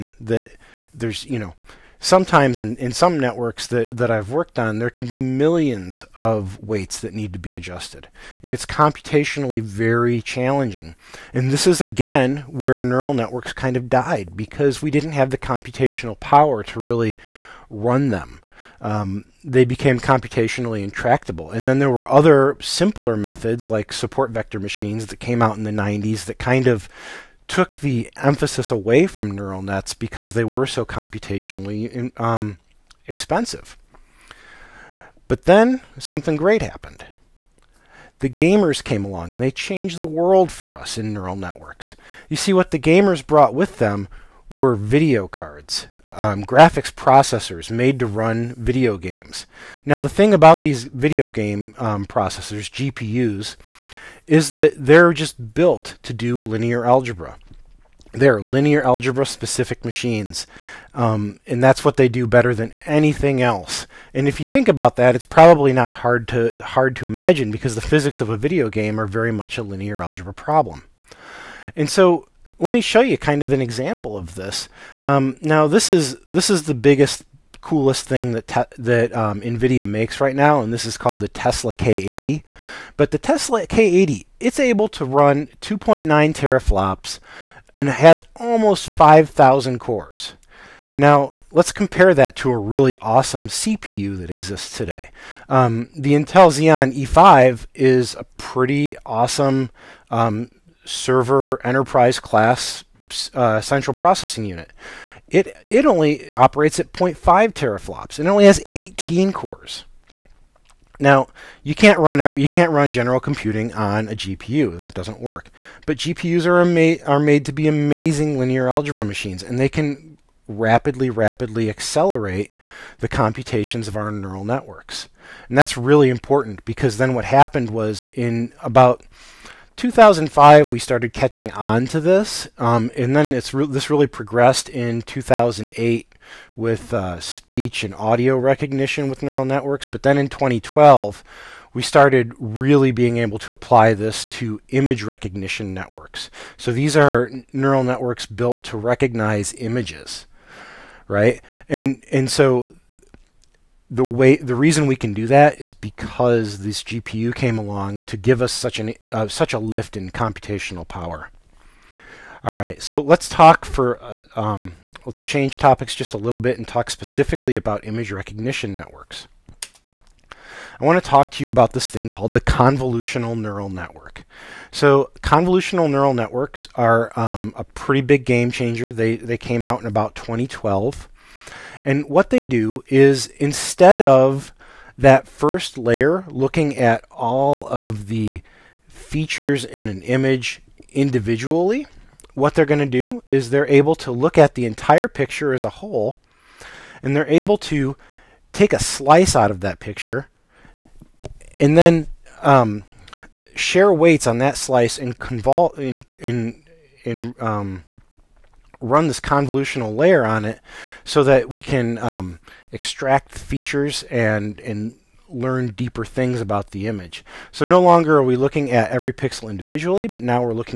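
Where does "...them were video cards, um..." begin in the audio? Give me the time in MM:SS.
00:43.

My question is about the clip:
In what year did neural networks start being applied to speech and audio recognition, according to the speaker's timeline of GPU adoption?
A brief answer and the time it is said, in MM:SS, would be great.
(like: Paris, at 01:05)
2008, at 02:15.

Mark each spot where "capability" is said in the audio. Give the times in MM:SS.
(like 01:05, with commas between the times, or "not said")
not said.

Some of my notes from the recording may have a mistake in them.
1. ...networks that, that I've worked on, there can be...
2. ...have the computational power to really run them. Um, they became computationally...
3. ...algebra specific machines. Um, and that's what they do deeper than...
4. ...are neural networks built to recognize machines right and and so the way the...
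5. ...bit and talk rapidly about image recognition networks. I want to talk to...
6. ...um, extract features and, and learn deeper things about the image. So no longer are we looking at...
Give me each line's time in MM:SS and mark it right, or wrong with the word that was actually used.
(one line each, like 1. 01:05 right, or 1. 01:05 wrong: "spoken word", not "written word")
1. 00:03 right
2. 00:15 right
3. 00:58 wrong: "better", not "deeper"
4. 02:26 wrong: "images", not "machines"
5. 02:46 wrong: "specifically", not "rapidly"
6. 03:31 right.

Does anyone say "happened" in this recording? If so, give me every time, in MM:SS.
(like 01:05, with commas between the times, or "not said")
00:36, 02:07.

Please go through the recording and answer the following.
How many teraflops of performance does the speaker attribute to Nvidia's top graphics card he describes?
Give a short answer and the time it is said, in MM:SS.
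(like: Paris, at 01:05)
2.9, at 01:25.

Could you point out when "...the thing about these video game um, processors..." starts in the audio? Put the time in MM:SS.
00:49.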